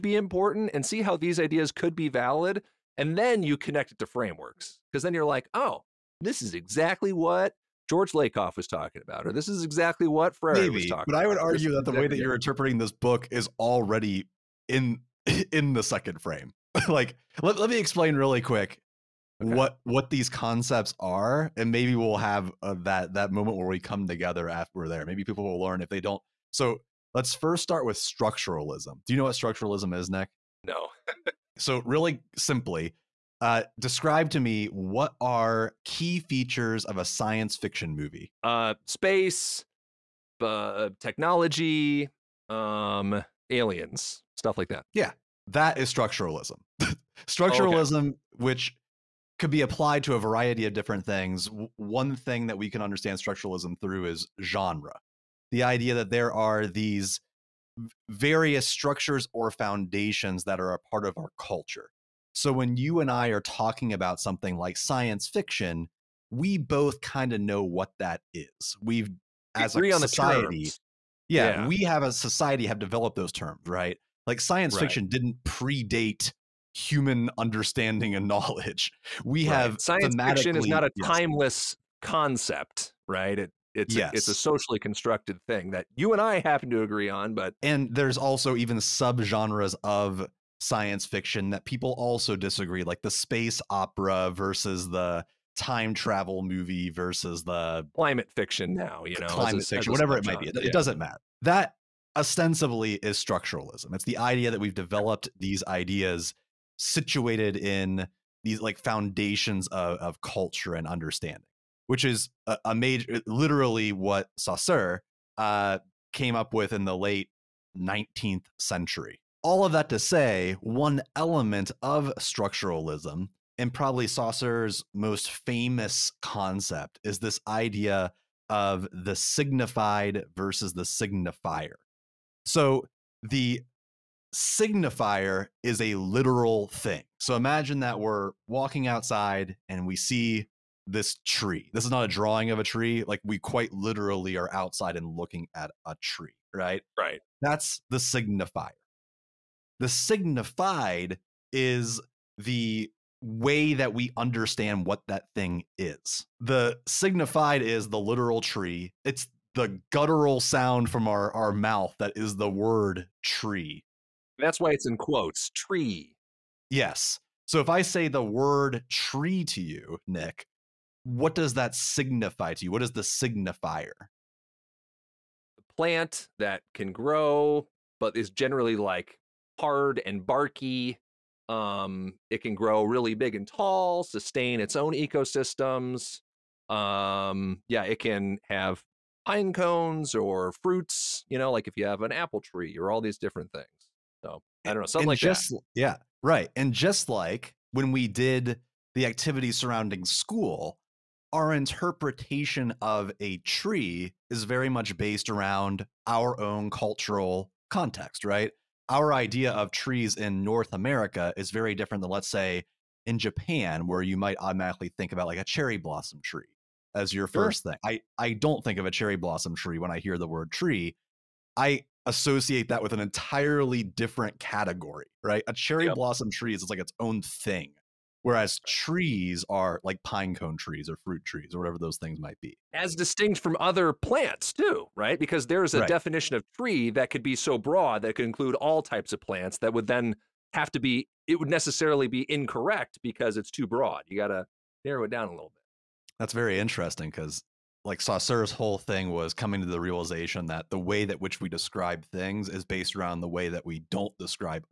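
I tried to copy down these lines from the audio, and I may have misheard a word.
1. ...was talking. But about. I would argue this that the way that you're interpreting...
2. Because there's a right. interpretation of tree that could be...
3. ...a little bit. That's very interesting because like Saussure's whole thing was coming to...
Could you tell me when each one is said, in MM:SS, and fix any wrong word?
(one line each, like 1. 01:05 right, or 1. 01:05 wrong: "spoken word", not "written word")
1. 00:10 right
2. 03:55 wrong: "definition", not "interpretation"
3. 04:05 right.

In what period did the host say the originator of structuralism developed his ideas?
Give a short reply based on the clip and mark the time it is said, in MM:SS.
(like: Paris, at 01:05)
Late 19th century, at 01:56.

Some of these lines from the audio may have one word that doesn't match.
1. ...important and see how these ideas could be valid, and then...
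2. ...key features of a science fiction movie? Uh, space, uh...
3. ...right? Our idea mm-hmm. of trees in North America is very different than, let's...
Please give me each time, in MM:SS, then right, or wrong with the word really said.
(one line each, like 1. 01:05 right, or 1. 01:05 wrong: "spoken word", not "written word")
1. 00:00 right
2. 00:35 right
3. 03:28 right.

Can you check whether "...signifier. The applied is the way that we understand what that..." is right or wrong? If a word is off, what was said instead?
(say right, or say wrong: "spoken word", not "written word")
wrong: "signified", not "applied".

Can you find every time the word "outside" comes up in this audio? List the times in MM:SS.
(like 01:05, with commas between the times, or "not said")
02:18, 02:24.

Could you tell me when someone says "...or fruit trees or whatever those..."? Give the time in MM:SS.
03:50.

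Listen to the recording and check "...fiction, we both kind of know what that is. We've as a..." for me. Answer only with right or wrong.
right.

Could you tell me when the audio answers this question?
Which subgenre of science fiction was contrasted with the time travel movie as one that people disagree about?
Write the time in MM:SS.
01:33.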